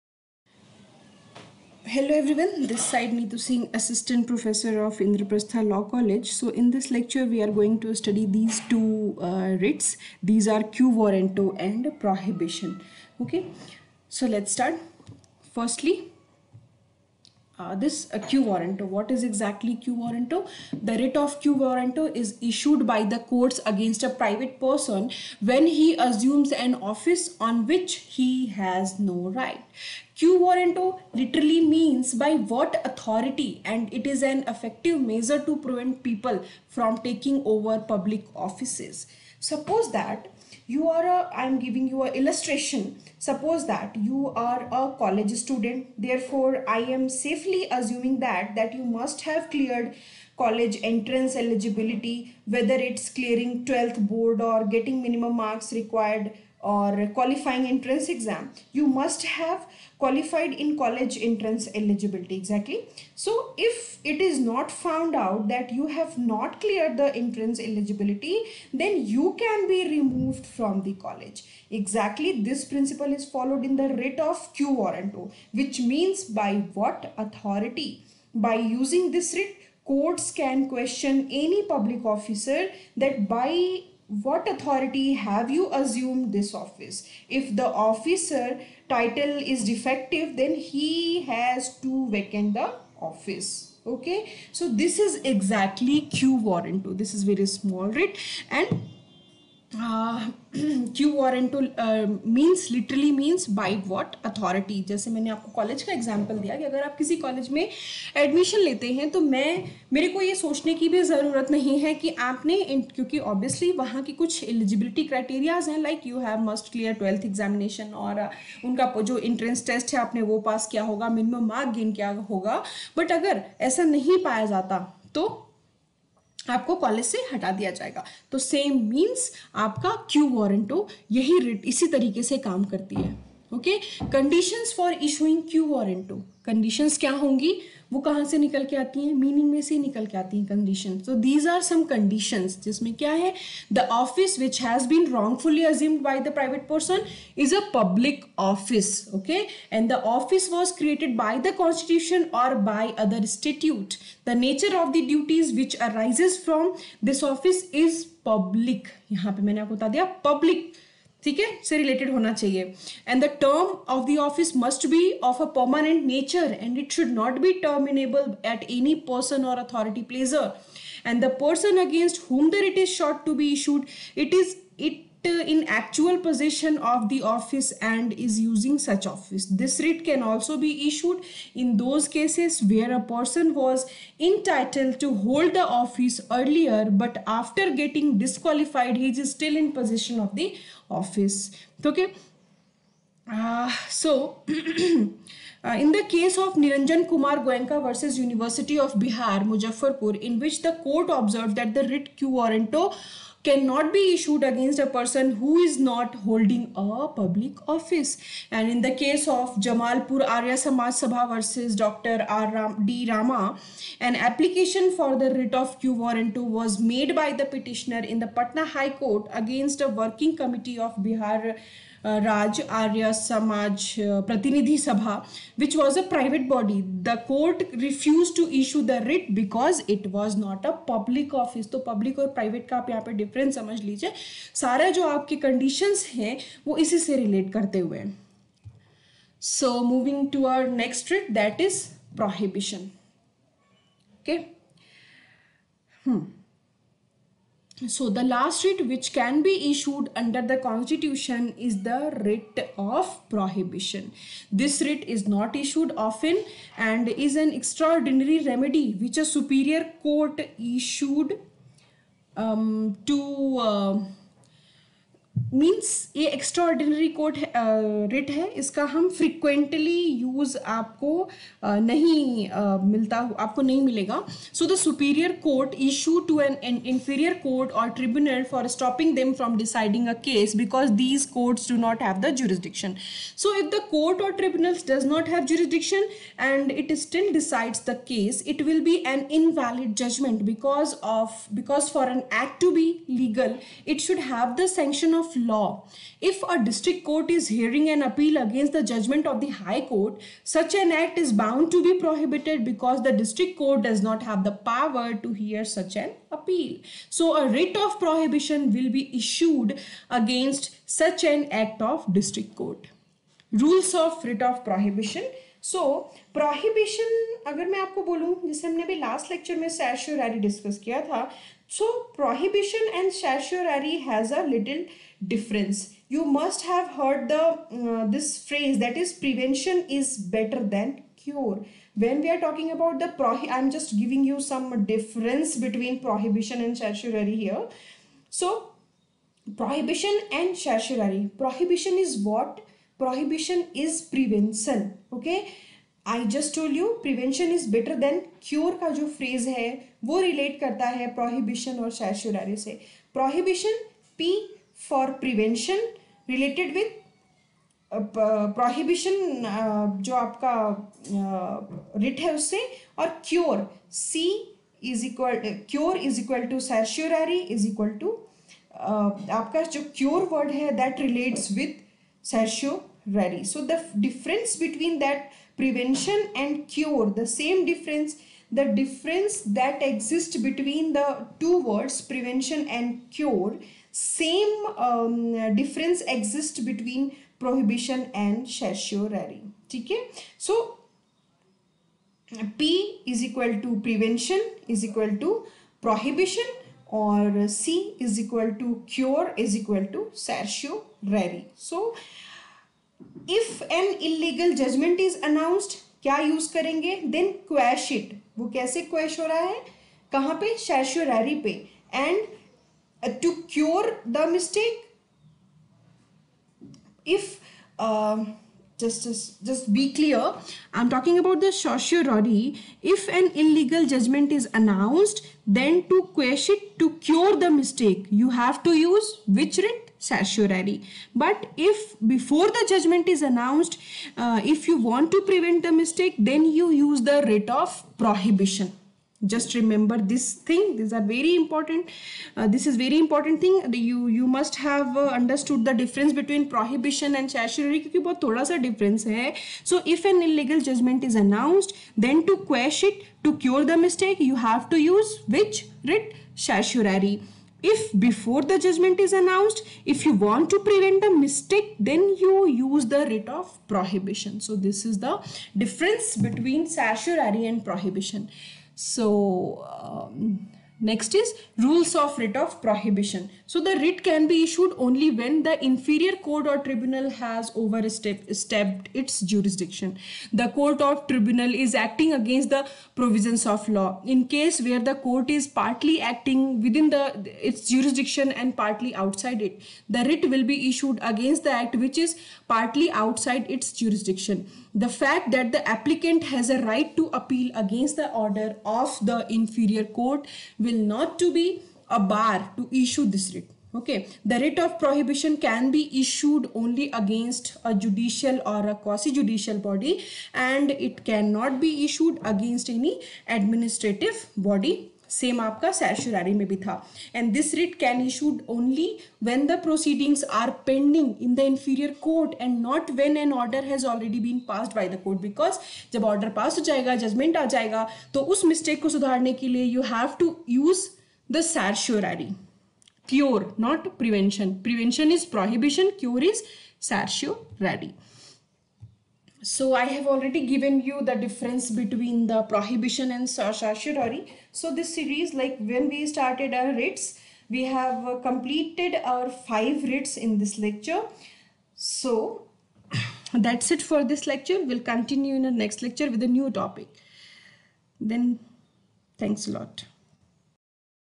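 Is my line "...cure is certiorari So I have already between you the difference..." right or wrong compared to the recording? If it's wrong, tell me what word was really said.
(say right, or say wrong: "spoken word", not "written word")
wrong: "given", not "between".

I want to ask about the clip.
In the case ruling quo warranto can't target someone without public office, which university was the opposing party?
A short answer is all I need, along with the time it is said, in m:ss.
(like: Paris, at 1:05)
University of Bihar, Muzaffarpur, at 3:18.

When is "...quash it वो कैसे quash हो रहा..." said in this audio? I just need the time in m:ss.
6:47.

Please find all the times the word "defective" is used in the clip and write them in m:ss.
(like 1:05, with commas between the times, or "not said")
1:29.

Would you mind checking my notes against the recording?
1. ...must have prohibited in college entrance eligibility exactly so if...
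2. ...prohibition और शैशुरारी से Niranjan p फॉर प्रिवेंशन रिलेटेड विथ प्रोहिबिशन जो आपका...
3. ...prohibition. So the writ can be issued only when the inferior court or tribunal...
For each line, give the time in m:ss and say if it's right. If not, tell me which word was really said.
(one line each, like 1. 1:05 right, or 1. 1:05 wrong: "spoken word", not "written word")
1. 0:58 wrong: "qualified", not "prohibited"
2. 5:51 wrong: "Prohibition", not "Niranjan"
3. 7:52 right.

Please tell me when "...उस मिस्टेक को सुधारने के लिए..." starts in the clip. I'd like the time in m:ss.
8:48.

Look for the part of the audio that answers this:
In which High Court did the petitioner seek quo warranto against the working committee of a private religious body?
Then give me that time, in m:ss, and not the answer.
3:38.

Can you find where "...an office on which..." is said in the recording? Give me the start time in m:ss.
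0:26.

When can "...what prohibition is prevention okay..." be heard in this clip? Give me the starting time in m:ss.
5:42.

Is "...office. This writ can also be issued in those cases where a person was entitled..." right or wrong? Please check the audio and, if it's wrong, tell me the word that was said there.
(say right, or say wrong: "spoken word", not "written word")
right.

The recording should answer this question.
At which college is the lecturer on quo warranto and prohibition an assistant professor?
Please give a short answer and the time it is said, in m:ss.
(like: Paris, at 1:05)
Indraprastha Law College, at 0:05.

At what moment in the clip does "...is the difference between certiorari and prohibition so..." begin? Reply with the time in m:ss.
7:44.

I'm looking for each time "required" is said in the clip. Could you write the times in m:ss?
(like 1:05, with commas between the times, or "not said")
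0:55.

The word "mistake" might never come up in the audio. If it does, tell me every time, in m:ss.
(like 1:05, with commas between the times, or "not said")
6:54, 7:07, 7:15, 7:33, 7:41.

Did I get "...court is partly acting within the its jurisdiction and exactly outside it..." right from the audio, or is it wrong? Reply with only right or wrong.
wrong.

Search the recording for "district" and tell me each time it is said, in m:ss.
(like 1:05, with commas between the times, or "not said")
4:56, 5:03, 5:12.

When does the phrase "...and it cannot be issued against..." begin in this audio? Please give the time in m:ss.
8:30.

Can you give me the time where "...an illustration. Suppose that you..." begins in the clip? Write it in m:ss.
0:42.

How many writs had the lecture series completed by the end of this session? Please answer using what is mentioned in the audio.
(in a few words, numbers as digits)
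5.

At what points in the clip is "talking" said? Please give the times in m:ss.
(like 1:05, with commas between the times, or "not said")
5:32, 7:00.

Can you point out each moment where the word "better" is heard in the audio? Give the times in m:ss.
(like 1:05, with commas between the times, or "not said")
5:30, 5:47.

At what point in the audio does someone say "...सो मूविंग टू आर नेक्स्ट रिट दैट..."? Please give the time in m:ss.
3:59.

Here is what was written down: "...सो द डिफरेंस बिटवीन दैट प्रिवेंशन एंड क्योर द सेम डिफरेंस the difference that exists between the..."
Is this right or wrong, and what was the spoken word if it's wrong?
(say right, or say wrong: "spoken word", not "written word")
right.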